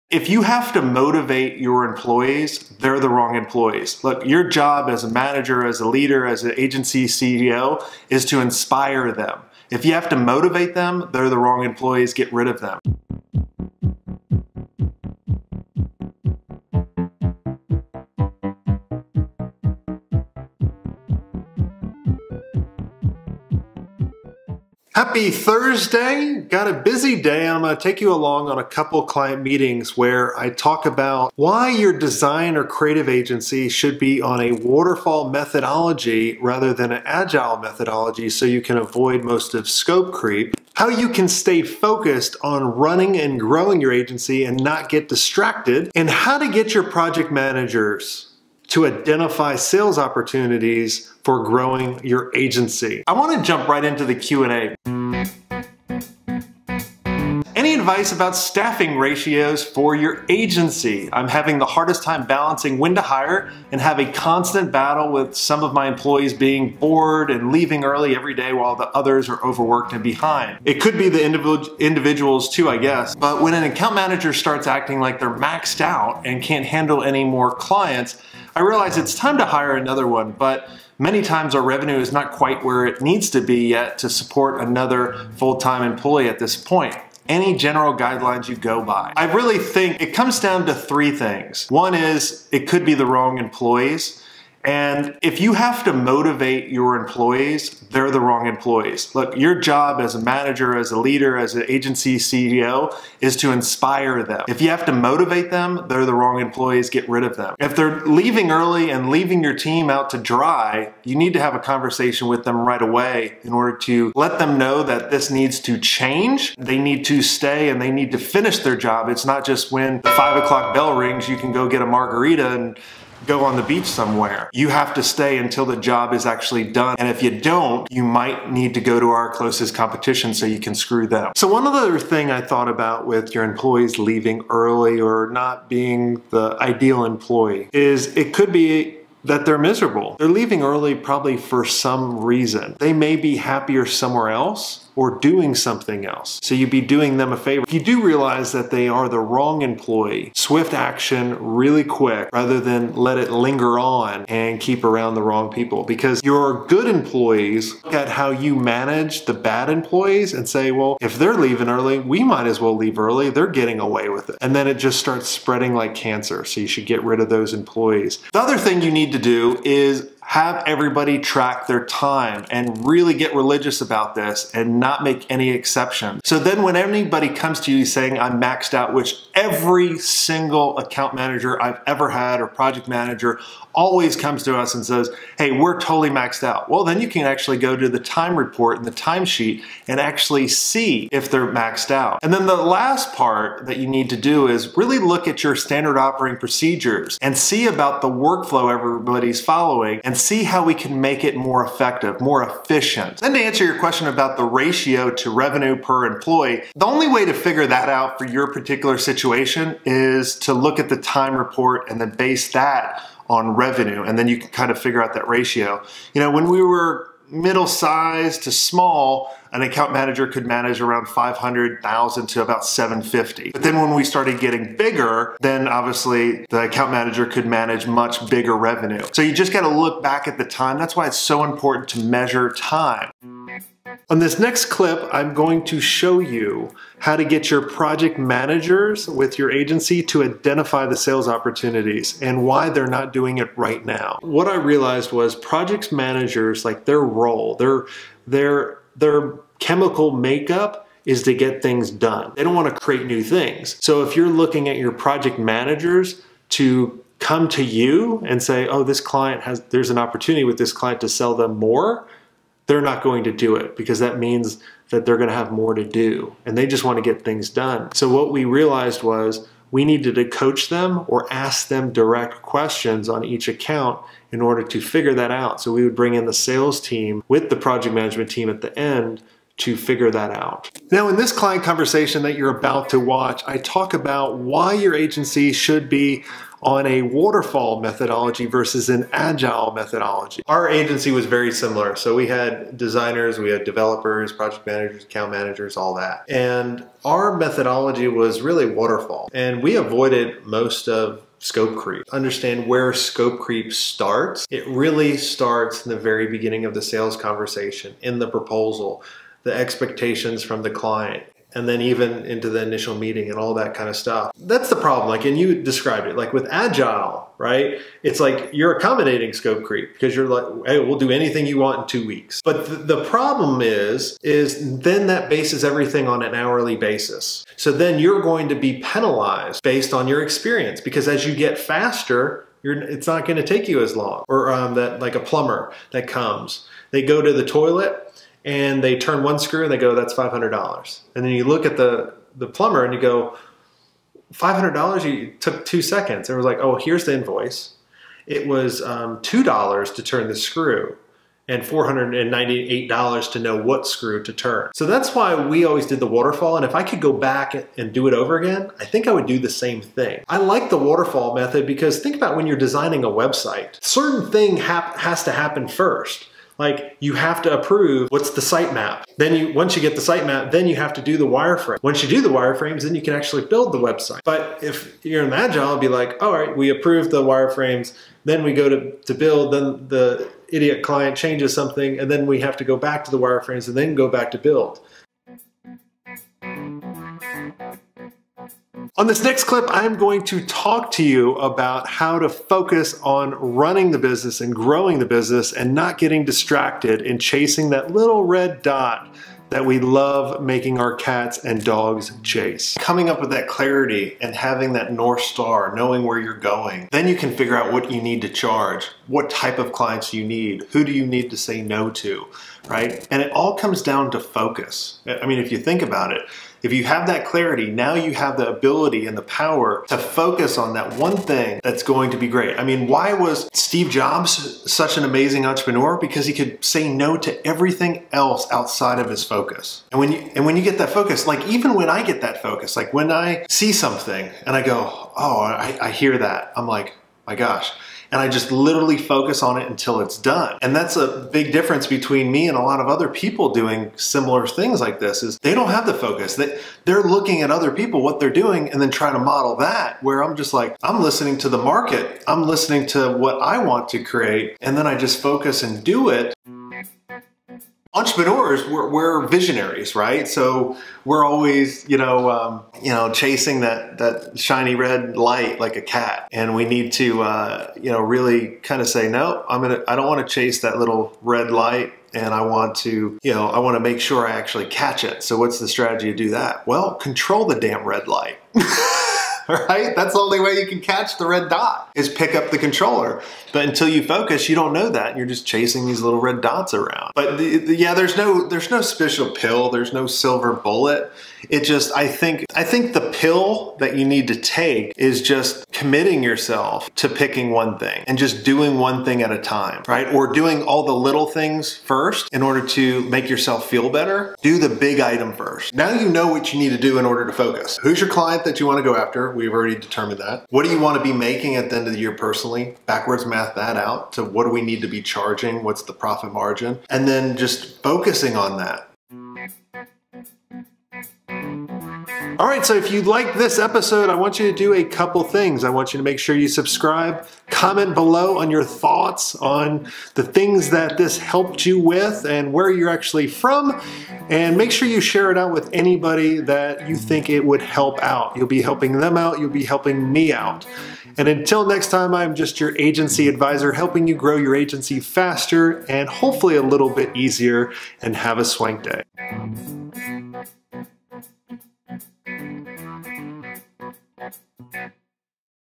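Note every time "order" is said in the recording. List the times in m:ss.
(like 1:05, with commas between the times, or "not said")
1:53, 4:34, 8:22, 8:27.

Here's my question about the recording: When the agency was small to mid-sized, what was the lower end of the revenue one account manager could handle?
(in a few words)
500,000.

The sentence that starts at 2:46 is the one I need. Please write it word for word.
So you should get rid of those employees.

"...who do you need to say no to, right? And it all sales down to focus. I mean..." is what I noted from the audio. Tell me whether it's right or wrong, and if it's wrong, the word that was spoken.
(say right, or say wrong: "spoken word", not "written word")
wrong: "comes", not "sales".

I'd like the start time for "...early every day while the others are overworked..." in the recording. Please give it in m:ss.
1:07.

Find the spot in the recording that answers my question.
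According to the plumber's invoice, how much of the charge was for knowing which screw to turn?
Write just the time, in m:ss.
5:51.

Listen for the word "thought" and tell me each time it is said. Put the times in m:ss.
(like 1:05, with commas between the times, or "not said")
2:12, 8:48.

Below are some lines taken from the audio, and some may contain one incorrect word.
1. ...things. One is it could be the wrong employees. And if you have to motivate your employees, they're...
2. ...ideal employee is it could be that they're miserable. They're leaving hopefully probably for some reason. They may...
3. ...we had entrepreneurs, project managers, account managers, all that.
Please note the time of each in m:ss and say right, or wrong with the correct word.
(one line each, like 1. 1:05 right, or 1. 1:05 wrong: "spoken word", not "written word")
1. 1:31 right
2. 2:16 wrong: "early", not "hopefully"
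3. 4:53 wrong: "developers", not "entrepreneurs".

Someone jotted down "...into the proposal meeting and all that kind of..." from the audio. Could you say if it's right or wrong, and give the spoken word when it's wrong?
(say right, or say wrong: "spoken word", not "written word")
wrong: "initial", not "proposal".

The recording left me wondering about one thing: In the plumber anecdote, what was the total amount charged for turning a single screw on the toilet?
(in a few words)
$500.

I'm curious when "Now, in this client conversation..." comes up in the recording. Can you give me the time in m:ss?
4:40.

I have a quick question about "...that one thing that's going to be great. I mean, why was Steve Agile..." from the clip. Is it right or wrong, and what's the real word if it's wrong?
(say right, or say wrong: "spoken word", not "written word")
wrong: "Jobs", not "Agile".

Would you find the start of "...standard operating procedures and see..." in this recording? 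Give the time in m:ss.
3:15.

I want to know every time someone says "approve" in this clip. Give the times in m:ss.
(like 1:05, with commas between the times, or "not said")
6:07, 6:16.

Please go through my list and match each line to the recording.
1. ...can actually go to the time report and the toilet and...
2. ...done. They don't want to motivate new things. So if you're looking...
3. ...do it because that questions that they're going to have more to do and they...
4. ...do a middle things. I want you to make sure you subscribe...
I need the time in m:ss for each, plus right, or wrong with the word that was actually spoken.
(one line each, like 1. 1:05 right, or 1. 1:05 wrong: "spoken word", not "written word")
1. 3:07 wrong: "timesheet", not "toilet"
2. 4:11 wrong: "create", not "motivate"
3. 4:23 wrong: "means", not "questions"
4. 8:44 wrong: "couple", not "middle".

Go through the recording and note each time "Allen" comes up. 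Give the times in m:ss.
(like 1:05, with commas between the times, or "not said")
not said.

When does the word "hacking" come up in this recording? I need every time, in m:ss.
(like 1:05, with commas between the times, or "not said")
not said.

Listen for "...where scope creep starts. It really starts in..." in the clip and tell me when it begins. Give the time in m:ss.
5:02.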